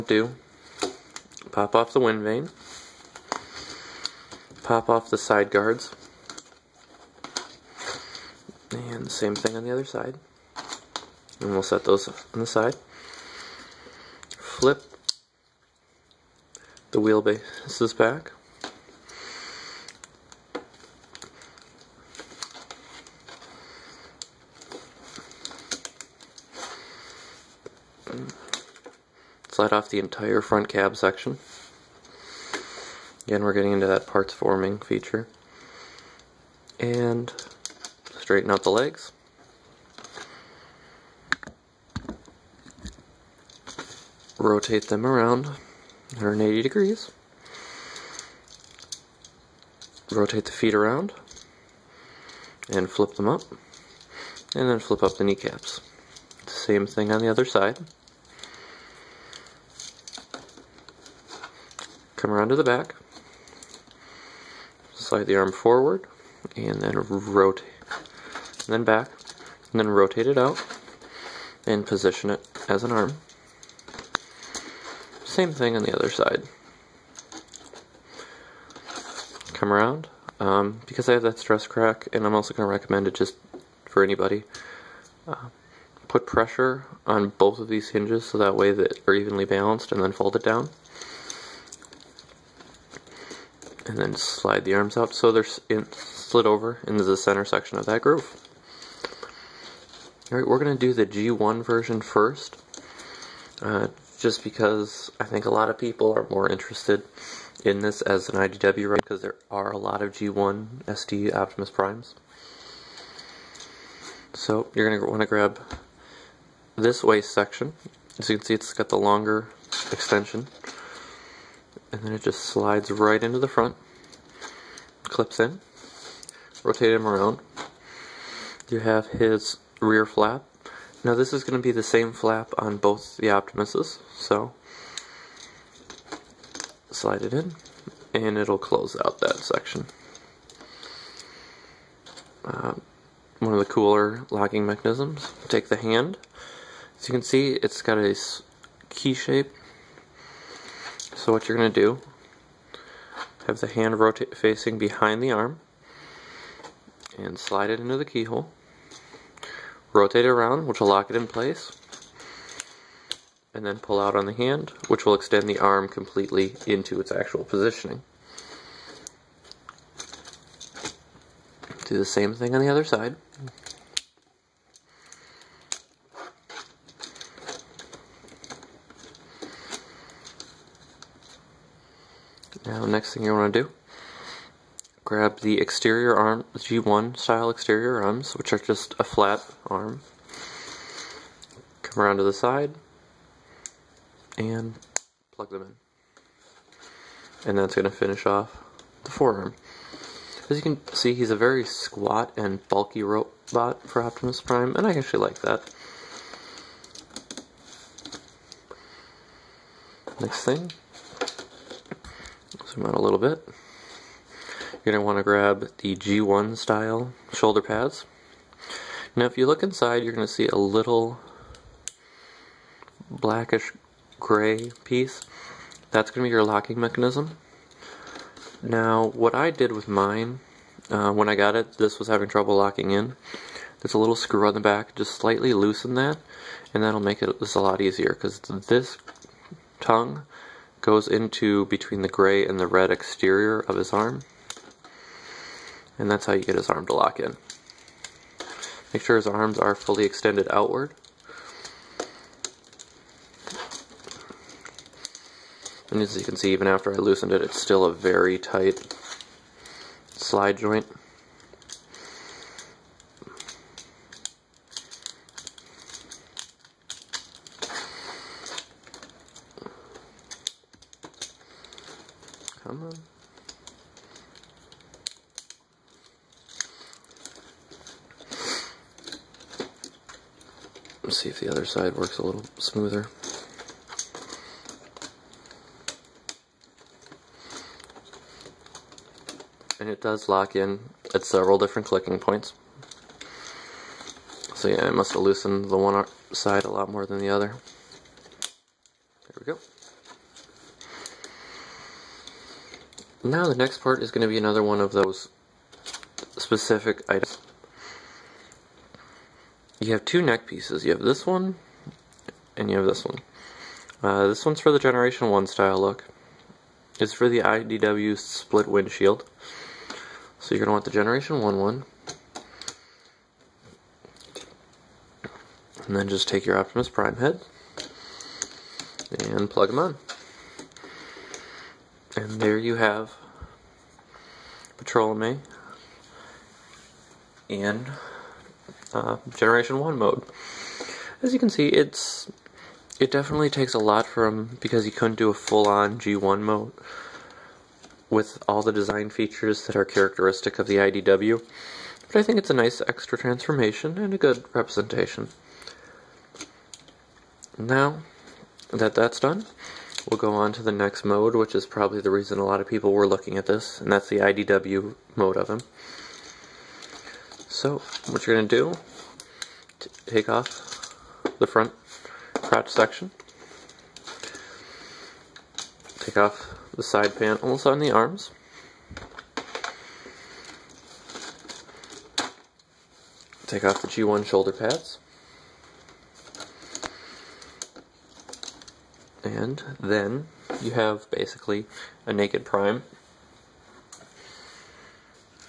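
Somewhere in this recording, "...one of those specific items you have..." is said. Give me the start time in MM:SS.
05:04.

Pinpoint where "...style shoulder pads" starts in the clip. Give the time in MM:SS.
03:36.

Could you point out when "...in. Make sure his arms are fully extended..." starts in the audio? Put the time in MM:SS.
04:07.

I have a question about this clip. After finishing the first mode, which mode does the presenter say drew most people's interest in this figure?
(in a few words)
IDW mode.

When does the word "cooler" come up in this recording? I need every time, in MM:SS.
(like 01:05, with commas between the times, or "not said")
02:23.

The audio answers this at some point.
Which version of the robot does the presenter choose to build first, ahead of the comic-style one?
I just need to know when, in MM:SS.
01:41.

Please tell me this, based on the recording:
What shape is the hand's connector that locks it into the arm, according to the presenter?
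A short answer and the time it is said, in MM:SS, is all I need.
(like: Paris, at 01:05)
key shape, at 02:28.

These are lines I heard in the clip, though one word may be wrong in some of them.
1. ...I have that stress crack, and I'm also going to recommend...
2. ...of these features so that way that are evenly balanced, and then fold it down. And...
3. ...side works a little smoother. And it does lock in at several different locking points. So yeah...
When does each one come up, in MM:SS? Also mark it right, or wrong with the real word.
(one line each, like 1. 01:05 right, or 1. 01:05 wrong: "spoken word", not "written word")
1. 01:21 right
2. 01:27 wrong: "hinges", not "features"
3. 04:41 wrong: "clicking", not "locking".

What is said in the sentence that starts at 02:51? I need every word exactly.
Do the same thing on the other side.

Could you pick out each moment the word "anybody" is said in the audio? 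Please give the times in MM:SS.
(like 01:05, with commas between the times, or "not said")
01:24.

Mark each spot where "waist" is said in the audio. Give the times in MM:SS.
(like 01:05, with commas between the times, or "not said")
01:57.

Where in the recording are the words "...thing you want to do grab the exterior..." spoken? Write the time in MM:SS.
03:03.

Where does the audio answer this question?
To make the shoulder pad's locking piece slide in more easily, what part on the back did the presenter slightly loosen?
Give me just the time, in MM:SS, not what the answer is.
03:53.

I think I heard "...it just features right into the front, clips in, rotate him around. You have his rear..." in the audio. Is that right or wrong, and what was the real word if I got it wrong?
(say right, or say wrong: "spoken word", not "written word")
wrong: "slides", not "features".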